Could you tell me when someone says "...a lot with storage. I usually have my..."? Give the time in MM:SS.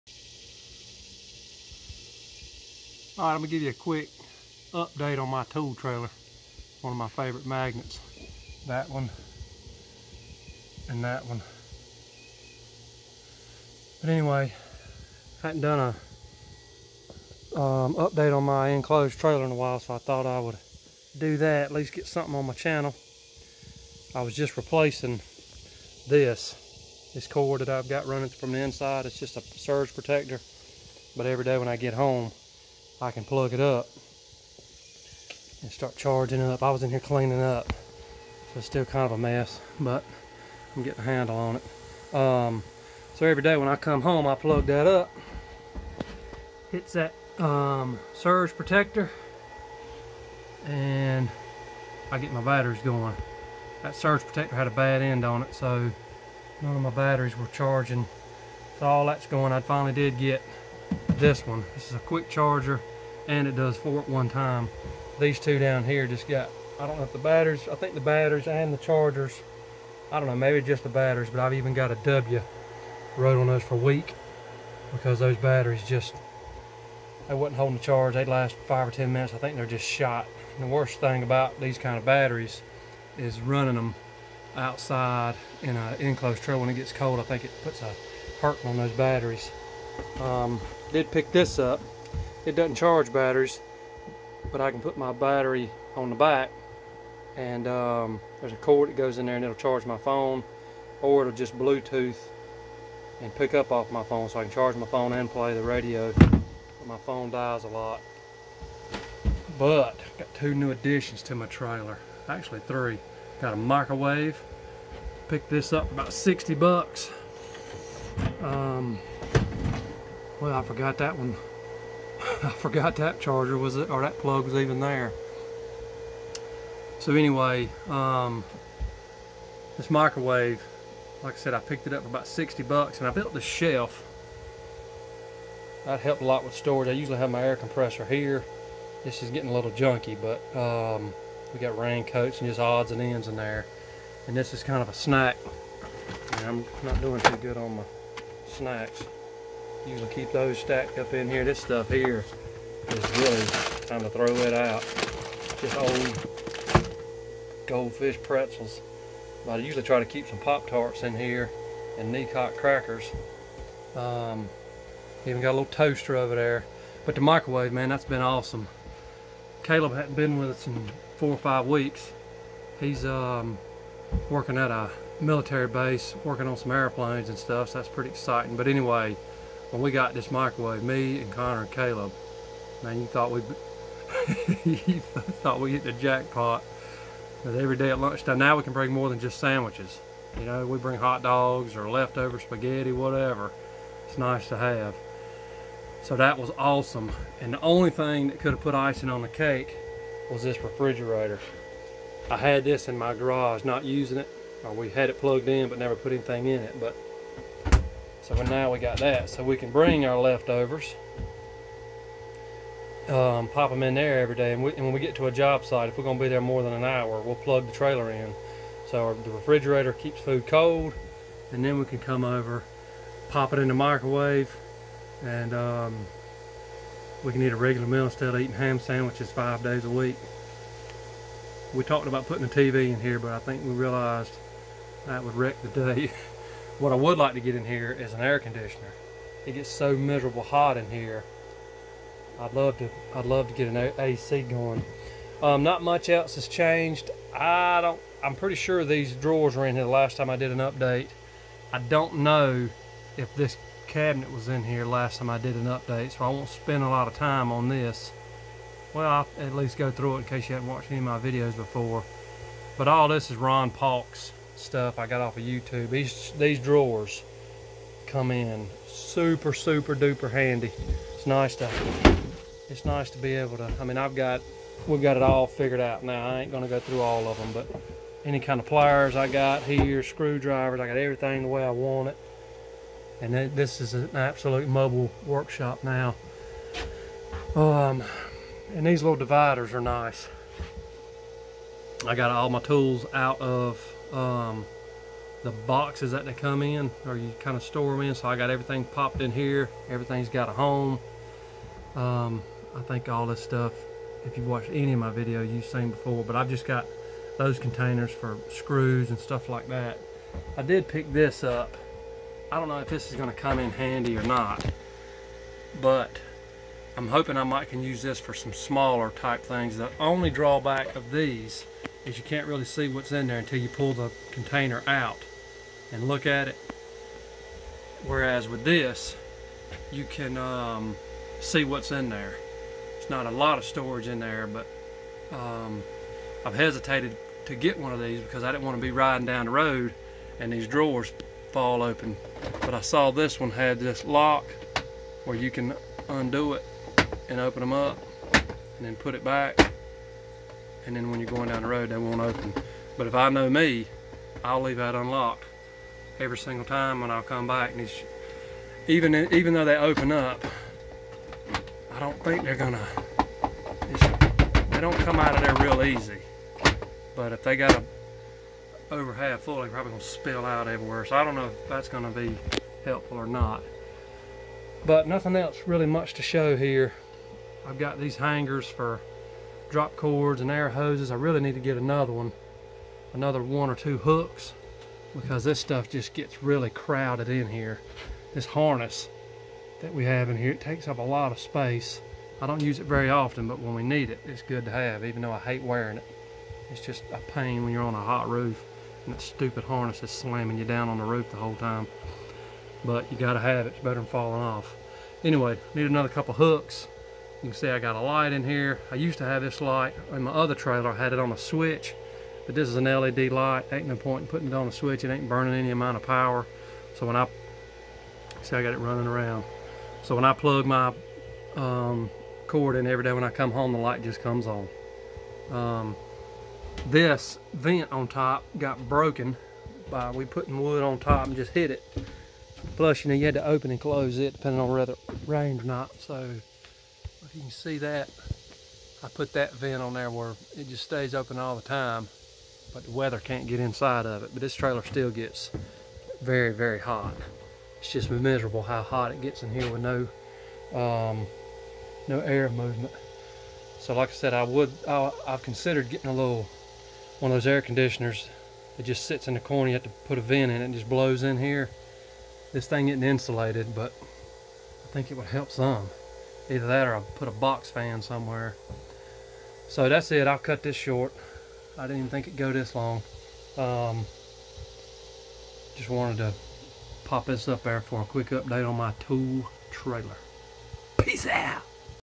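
02:16.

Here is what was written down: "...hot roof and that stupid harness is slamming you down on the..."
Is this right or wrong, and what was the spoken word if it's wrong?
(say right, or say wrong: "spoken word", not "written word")
right.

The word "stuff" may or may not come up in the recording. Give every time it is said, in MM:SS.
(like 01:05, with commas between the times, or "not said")
02:31, 02:57, 04:24, 05:03, 05:09, 06:25.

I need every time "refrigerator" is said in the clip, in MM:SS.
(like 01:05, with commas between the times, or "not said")
03:20, 03:39.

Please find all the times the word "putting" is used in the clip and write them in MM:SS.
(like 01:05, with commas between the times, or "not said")
03:52, 06:54, 07:10.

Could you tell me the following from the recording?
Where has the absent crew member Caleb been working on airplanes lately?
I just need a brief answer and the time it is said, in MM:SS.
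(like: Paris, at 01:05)
military base, at 02:55.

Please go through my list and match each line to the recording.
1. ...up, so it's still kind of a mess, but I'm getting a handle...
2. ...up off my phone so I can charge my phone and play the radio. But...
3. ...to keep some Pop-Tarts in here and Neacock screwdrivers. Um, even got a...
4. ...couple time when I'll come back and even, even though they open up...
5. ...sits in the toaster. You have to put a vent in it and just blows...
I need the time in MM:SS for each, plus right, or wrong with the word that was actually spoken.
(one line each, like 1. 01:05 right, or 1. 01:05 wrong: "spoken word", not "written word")
1. 00:37 right
2. 01:43 right
3. 02:39 wrong: "crackers", not "screwdrivers"
4. 05:56 wrong: "single", not "couple"
5. 07:39 wrong: "corner", not "toaster".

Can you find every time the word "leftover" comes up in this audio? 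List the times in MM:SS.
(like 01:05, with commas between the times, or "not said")
03:11, 03:30.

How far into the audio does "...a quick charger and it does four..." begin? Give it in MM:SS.
01:01.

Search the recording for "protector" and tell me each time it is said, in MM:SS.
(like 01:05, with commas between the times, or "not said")
00:29, 00:48, 00:54.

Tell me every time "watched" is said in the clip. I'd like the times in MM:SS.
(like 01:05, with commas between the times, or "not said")
04:20, 05:04.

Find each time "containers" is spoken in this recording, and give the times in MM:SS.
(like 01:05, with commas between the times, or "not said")
05:07, 05:24.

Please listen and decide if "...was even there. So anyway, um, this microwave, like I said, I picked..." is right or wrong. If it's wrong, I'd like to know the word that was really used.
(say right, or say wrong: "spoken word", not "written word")
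right.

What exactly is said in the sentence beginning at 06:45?
Anyway, need another couple hooks you can see I got a light in here.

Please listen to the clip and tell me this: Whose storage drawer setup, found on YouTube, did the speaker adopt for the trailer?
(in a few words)
Ron Paul.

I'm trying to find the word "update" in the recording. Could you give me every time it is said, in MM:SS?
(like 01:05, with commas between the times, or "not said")
00:04, 00:17, 04:10, 04:15, 07:58.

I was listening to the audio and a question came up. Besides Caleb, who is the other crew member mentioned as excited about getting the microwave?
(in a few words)
Connor.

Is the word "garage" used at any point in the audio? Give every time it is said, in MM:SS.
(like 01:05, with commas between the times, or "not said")
03:23.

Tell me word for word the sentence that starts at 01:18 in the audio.
They'd last five or 10 minutes.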